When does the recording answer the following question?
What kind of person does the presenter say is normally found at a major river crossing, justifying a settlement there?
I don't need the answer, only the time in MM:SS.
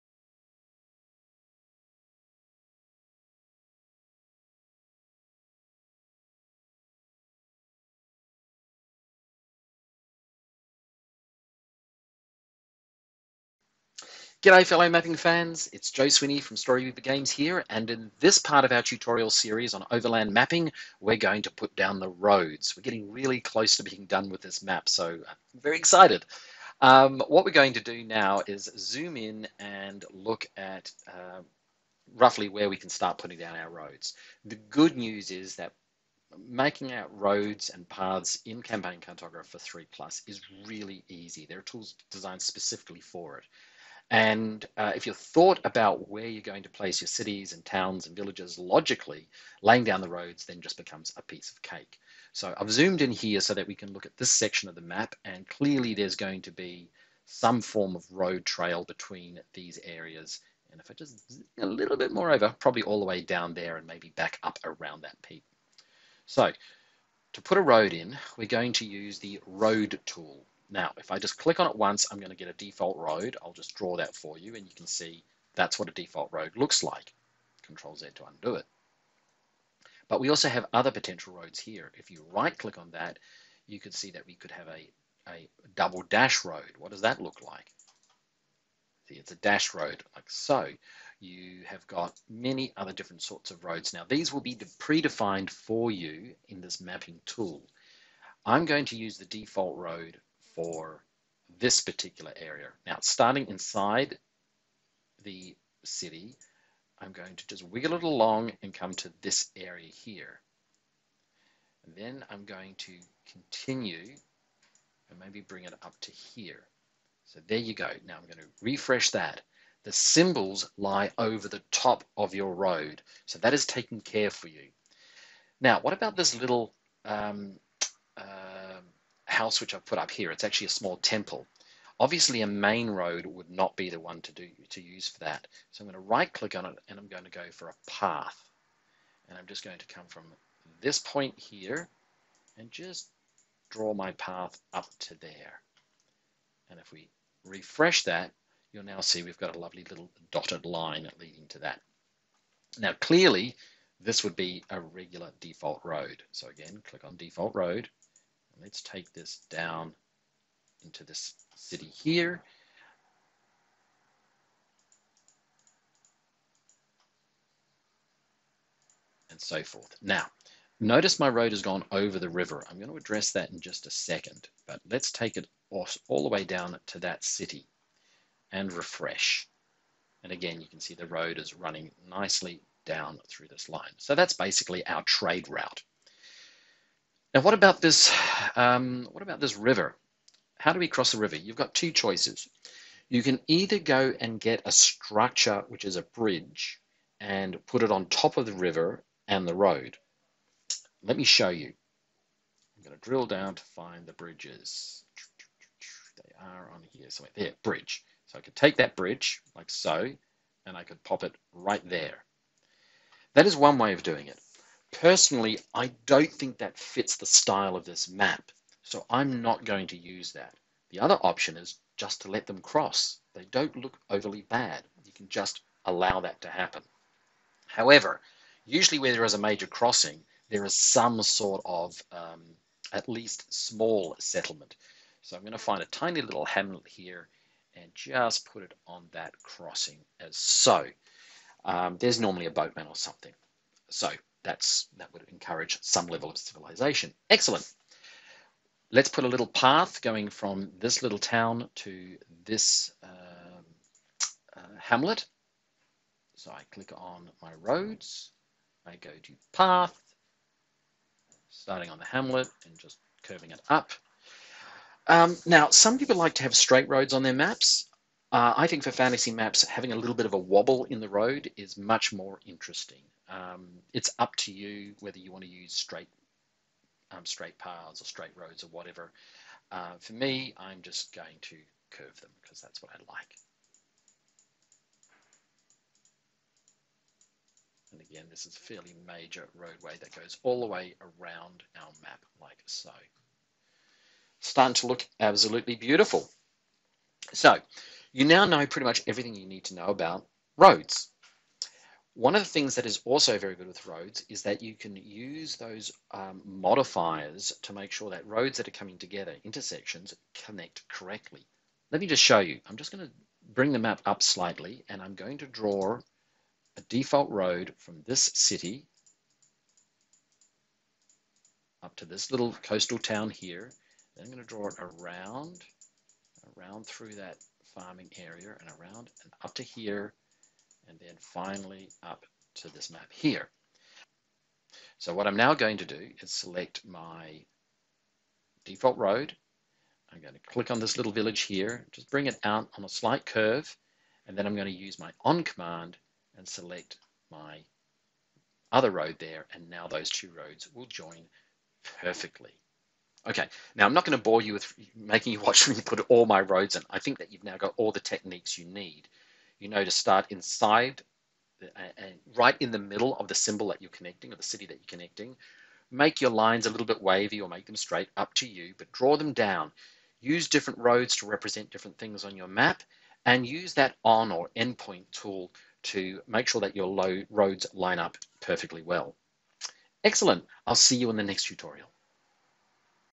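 04:02.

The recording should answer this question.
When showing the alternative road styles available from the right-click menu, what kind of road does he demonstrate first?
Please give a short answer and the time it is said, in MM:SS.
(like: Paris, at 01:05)
Double dash road, at 01:25.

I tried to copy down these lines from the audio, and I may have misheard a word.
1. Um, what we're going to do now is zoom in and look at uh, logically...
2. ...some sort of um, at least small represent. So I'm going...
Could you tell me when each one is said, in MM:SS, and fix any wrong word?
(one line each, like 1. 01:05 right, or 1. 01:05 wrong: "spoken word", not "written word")
1. 00:26 wrong: "roughly", not "logically"
2. 03:50 wrong: "settlement", not "represent".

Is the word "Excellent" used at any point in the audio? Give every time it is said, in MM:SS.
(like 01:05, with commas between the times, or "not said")
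04:07, 06:20.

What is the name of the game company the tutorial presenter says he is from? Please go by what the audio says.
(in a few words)
Storyweaver Games.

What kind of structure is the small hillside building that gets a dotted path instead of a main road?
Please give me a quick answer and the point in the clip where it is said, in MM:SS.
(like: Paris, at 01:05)
A small temple, at 02:10.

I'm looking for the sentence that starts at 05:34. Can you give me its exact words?
So what I'm now going to do is select my default road.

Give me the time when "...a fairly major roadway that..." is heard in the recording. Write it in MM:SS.
04:48.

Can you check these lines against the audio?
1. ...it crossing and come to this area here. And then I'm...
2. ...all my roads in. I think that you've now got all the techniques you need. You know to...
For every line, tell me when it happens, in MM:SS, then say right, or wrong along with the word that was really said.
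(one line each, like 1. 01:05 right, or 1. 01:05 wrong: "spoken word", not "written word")
1. 01:47 wrong: "along", not "crossing"
2. 05:56 right.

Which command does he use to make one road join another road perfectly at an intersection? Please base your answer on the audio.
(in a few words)
On command.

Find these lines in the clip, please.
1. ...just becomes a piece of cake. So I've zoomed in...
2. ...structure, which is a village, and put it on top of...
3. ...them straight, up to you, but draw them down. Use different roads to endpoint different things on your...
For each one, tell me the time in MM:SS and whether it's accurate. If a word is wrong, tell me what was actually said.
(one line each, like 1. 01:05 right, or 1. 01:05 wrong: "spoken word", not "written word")
1. 00:50 right
2. 03:14 wrong: "bridge", not "village"
3. 06:07 wrong: "represent", not "endpoint".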